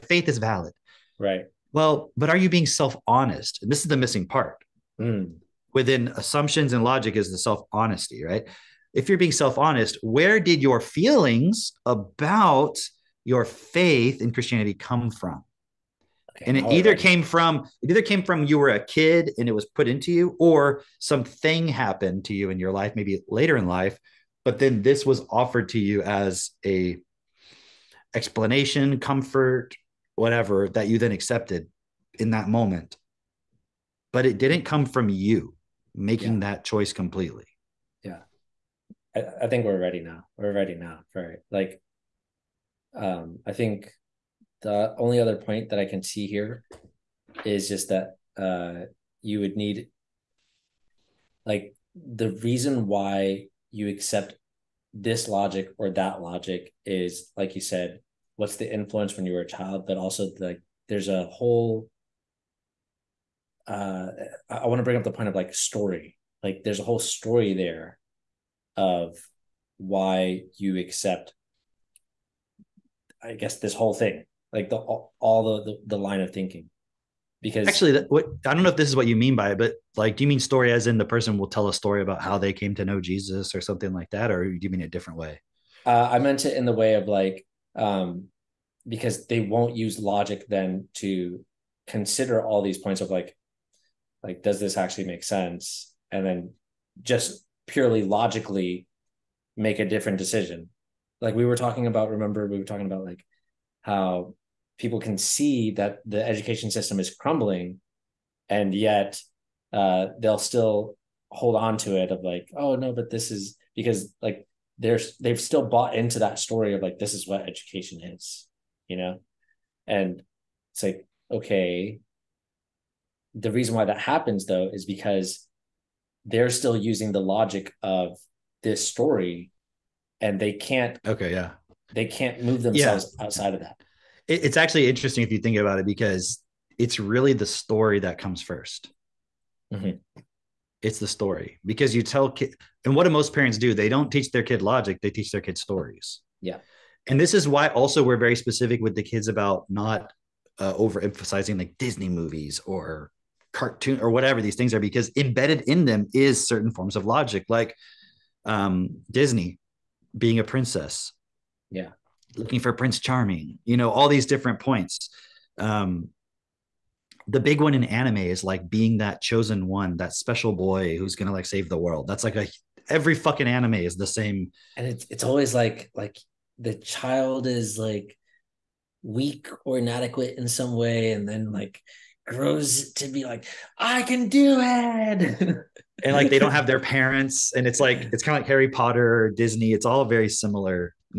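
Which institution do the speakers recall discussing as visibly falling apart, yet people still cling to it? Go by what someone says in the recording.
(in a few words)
the education system.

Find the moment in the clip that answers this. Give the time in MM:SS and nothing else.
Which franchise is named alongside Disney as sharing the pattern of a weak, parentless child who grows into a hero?
03:08.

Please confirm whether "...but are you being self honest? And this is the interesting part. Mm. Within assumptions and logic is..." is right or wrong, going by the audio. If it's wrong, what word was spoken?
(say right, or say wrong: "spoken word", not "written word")
wrong: "missing", not "interesting".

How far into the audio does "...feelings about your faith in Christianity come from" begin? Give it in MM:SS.
00:10.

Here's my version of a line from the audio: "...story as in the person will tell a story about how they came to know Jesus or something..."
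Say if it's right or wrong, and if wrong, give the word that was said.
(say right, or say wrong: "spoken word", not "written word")
right.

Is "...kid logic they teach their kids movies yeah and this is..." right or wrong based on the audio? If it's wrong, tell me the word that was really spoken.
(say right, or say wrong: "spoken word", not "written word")
wrong: "stories", not "movies".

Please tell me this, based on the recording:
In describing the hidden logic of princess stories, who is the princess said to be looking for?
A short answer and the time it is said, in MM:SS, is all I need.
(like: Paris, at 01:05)
Prince Charming, at 02:42.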